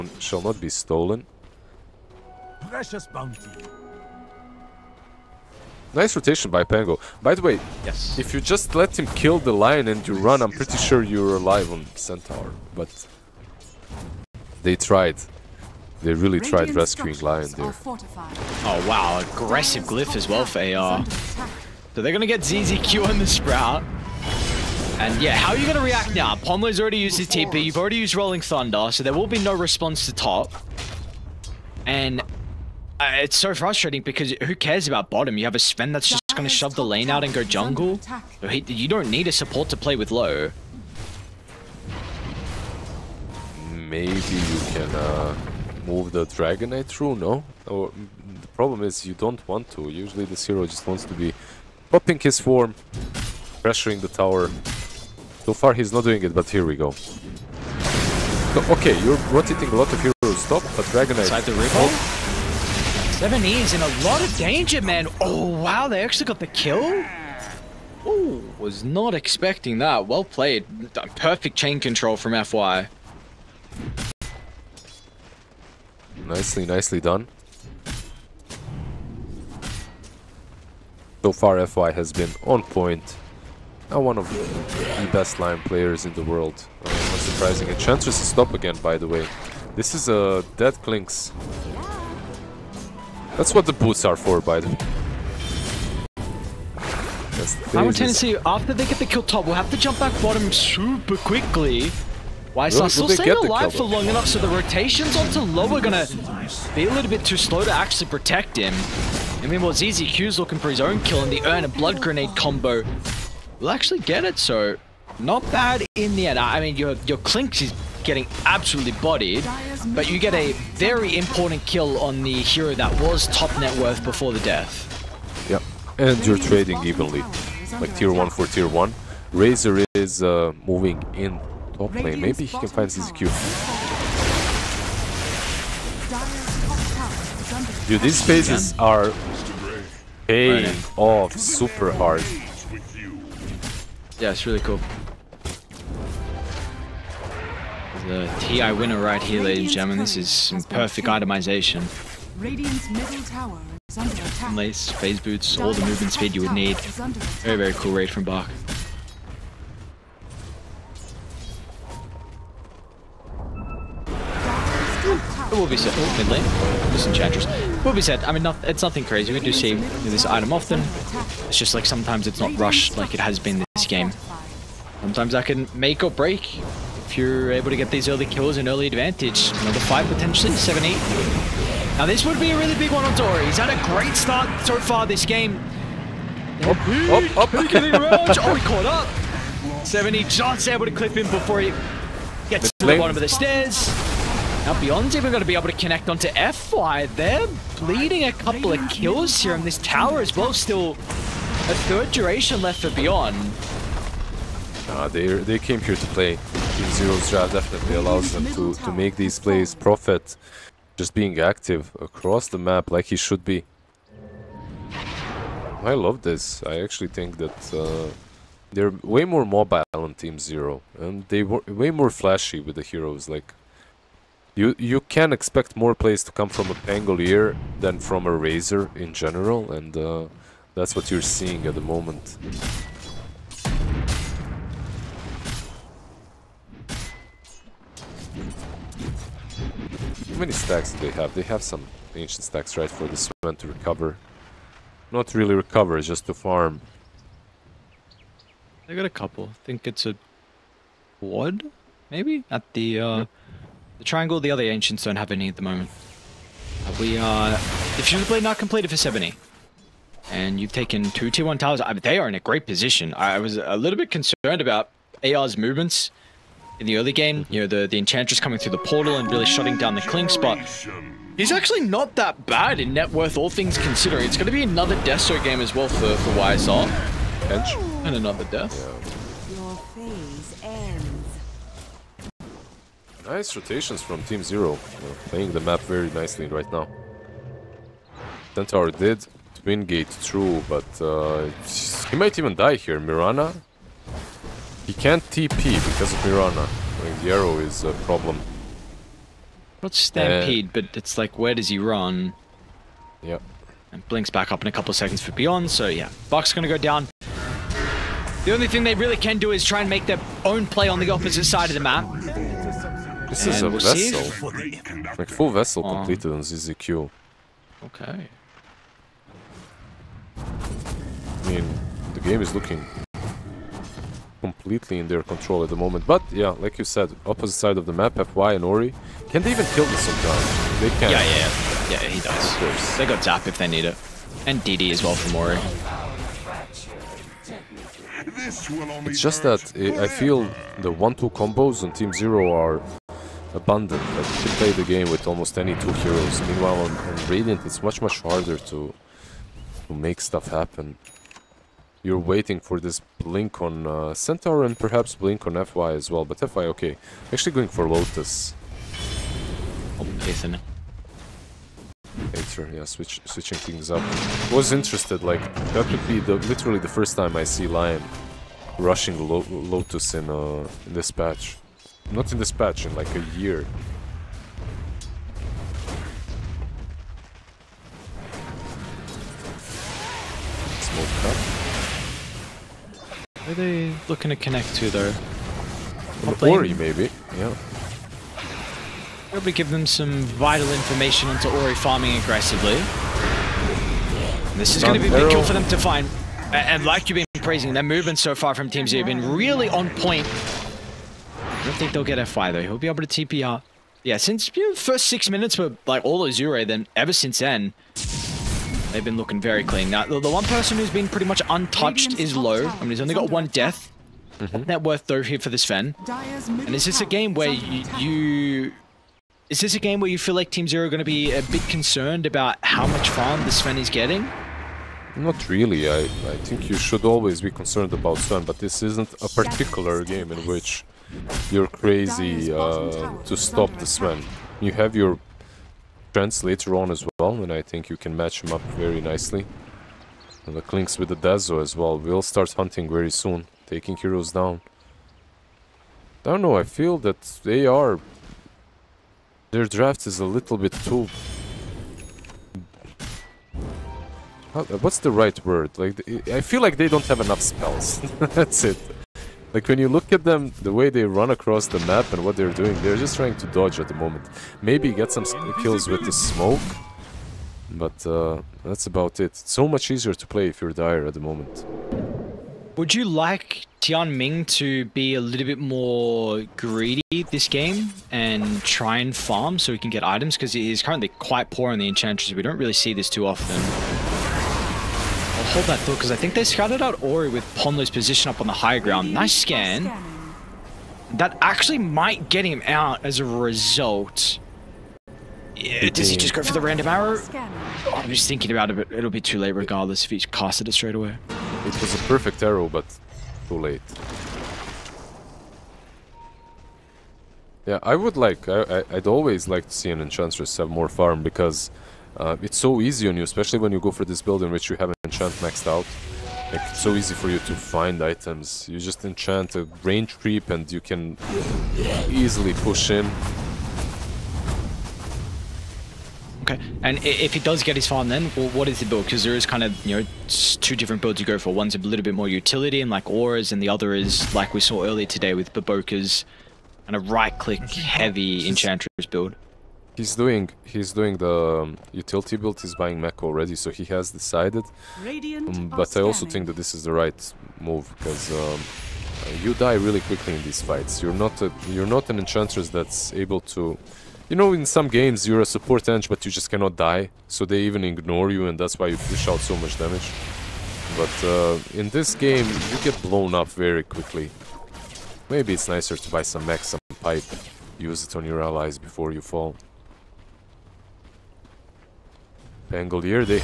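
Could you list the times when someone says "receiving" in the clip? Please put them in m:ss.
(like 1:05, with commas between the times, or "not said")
not said.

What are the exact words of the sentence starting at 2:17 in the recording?
Dude, these phases are paying off super hard.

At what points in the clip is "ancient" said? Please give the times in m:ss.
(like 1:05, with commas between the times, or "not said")
4:02, 4:14.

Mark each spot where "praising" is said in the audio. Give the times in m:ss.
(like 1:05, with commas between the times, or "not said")
6:37.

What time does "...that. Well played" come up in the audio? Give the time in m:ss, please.
1:09.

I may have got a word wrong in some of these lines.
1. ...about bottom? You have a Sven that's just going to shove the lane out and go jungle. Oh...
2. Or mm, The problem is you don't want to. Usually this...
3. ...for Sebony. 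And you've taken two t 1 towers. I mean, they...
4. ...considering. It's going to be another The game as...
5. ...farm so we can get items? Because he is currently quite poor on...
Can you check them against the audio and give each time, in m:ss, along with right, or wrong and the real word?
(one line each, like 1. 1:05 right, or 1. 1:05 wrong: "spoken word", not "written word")
1. 0:34 right
2. 0:47 right
3. 4:18 right
4. 4:33 wrong: "Deso", not "The"
5. 7:59 right.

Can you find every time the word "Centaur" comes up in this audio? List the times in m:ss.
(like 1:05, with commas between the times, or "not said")
0:11, 4:48, 5:54.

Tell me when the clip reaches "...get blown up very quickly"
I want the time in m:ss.
9:22.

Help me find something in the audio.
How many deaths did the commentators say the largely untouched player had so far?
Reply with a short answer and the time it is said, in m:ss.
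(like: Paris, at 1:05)
1, at 6:53.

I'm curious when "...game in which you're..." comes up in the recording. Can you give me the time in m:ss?
7:10.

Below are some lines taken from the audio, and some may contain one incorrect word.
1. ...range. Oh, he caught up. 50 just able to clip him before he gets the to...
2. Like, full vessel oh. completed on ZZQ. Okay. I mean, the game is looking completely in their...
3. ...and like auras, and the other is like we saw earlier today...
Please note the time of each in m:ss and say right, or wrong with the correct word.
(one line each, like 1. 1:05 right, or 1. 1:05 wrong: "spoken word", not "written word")
1. 3:07 wrong: "70", not "50"
2. 5:15 right
3. 8:52 right.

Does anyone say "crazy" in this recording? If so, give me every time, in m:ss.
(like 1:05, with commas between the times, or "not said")
2:49, 7:11.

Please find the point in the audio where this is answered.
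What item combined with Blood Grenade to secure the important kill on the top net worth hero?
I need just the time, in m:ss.
1:51.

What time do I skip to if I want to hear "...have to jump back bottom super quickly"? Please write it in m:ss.
1:39.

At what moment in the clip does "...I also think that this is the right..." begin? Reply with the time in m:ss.
9:05.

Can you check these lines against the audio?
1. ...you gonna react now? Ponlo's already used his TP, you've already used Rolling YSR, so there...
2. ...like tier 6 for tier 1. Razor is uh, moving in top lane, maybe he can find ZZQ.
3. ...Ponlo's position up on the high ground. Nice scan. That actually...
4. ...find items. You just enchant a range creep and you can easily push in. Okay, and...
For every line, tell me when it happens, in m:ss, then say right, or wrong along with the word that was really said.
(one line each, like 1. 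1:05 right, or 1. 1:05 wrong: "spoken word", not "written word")
1. 0:25 wrong: "Thunder", not "YSR"
2. 2:07 wrong: "1", not "6"
3. 8:07 right
4. 8:37 right.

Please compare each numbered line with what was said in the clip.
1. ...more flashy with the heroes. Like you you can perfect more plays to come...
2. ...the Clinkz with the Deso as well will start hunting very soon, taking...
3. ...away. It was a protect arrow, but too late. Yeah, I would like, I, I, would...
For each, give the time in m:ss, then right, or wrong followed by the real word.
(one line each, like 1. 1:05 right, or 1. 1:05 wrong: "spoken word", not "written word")
1. 3:41 wrong: "expect", not "perfect"
2. 7:20 right
3. 8:20 wrong: "perfect", not "protect".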